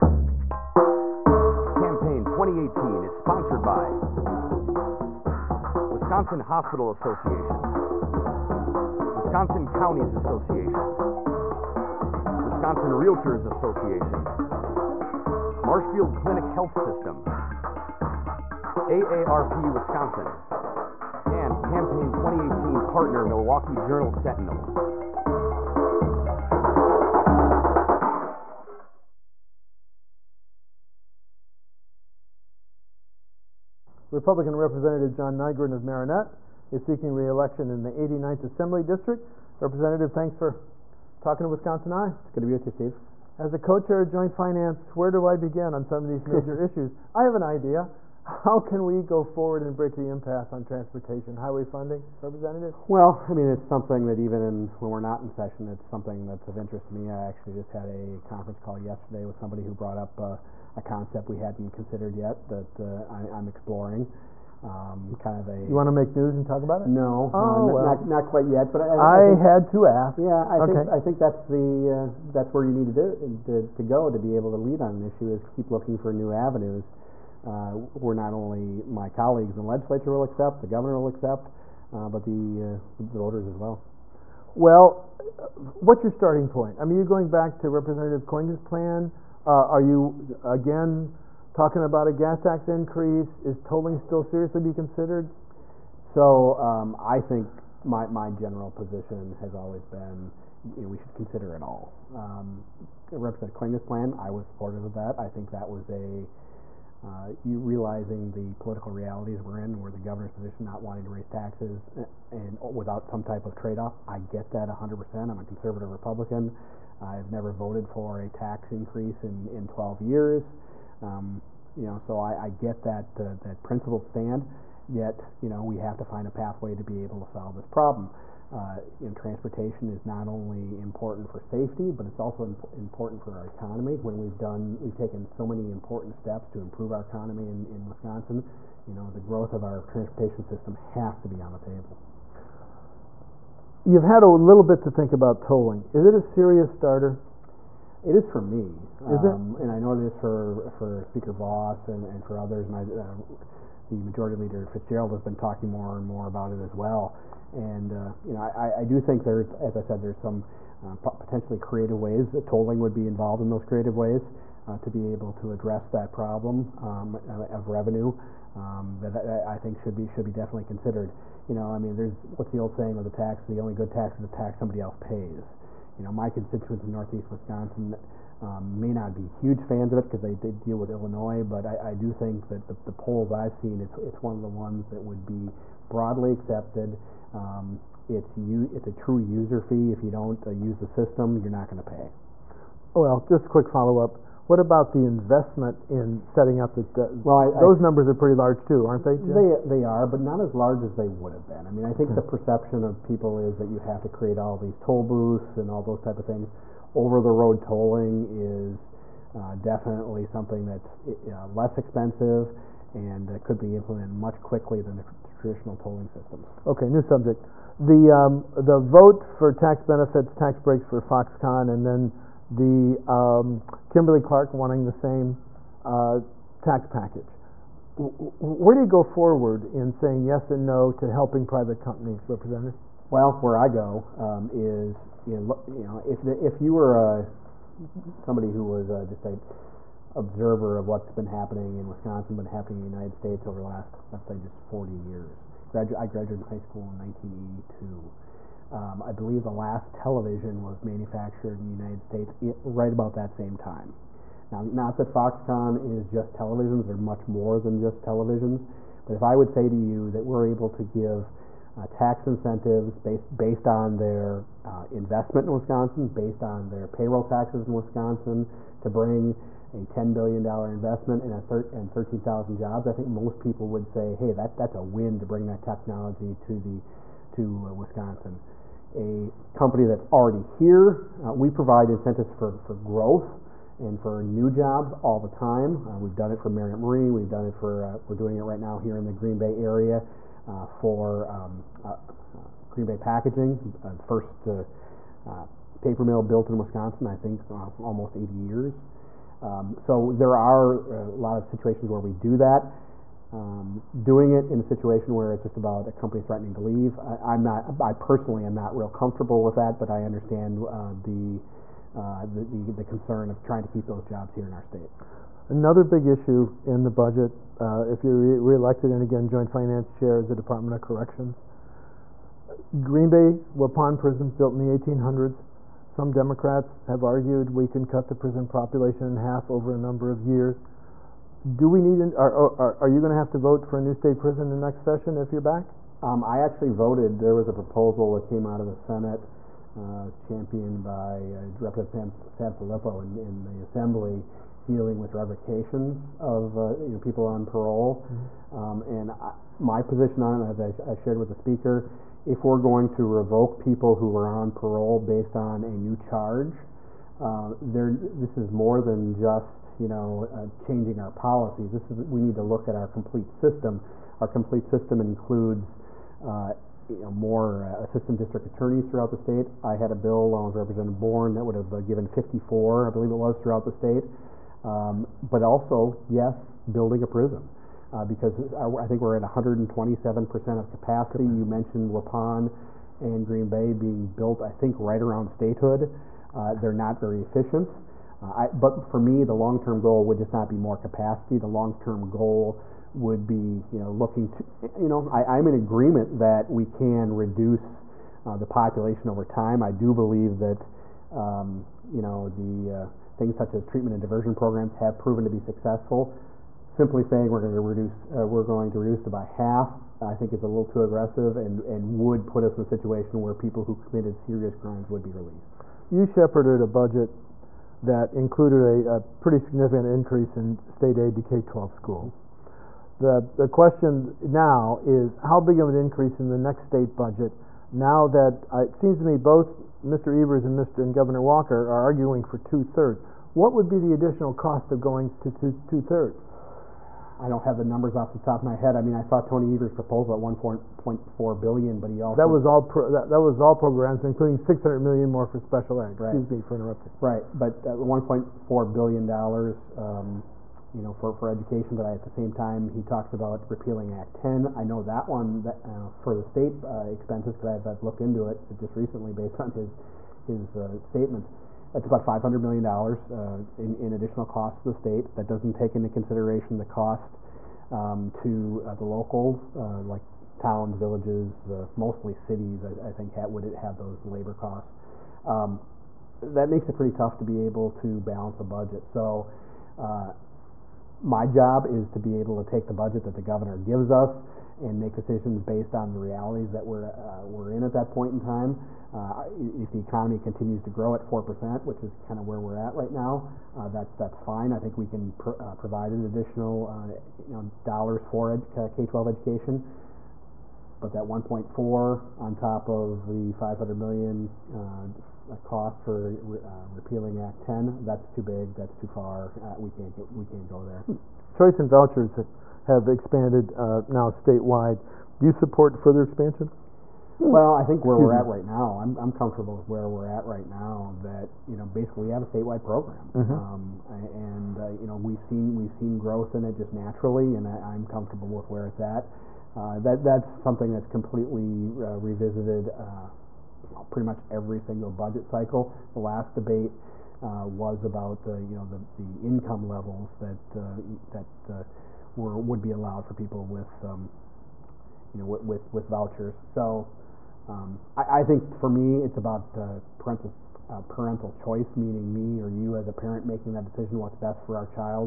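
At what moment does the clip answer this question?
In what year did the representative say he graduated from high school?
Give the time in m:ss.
4:06.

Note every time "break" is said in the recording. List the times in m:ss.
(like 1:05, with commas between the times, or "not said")
0:49, 3:40.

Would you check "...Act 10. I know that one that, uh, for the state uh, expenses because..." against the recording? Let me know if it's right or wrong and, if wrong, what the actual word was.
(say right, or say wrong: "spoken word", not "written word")
right.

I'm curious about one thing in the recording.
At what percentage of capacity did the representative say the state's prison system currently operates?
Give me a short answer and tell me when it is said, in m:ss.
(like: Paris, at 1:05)
127%, at 6:19.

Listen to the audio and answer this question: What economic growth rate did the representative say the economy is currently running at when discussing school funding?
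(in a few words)
4%.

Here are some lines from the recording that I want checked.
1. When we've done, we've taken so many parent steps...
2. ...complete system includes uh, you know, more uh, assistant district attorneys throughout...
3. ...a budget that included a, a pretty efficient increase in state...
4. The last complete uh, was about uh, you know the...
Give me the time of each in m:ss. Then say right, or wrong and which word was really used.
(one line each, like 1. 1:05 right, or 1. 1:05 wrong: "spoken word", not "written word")
1. 2:13 wrong: "important", not "parent"
2. 6:04 right
3. 6:56 wrong: "significant", not "efficient"
4. 8:55 wrong: "debate", not "complete".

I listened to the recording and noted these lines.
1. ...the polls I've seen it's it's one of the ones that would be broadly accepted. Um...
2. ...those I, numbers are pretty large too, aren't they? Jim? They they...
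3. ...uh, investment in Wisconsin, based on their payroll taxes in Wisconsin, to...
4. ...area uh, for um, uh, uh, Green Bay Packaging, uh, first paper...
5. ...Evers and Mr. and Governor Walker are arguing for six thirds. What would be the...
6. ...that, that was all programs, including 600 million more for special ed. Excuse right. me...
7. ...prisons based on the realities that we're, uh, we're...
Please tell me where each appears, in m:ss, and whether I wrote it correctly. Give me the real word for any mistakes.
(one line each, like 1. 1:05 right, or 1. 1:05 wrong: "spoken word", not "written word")
1. 3:02 right
2. 3:17 right
3. 4:24 right
4. 4:49 right
5. 7:10 wrong: "two", not "six"
6. 7:22 right
7. 8:04 wrong: "decisions", not "prisons".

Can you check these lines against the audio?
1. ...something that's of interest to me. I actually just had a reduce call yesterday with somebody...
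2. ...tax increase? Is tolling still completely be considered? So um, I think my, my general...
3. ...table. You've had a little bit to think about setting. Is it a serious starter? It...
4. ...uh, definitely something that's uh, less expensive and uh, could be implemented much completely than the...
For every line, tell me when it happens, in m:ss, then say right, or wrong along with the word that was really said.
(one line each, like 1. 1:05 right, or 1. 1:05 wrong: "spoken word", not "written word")
1. 0:55 wrong: "conference", not "reduce"
2. 1:32 wrong: "seriously", not "completely"
3. 2:21 wrong: "tolling", not "setting"
4. 3:29 wrong: "quickly", not "completely".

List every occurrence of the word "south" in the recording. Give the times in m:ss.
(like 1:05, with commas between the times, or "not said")
not said.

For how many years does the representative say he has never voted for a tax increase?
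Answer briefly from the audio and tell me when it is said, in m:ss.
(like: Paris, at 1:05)
12 years, at 1:59.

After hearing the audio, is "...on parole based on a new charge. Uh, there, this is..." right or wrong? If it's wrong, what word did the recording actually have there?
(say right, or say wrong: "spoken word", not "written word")
right.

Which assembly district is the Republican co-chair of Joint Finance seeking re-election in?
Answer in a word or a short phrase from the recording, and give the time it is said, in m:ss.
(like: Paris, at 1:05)
89th, at 0:37.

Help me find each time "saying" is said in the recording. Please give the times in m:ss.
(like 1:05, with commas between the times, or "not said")
2:52, 3:49, 6:47.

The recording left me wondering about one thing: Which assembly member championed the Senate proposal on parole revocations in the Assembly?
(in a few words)
Sanfelippo.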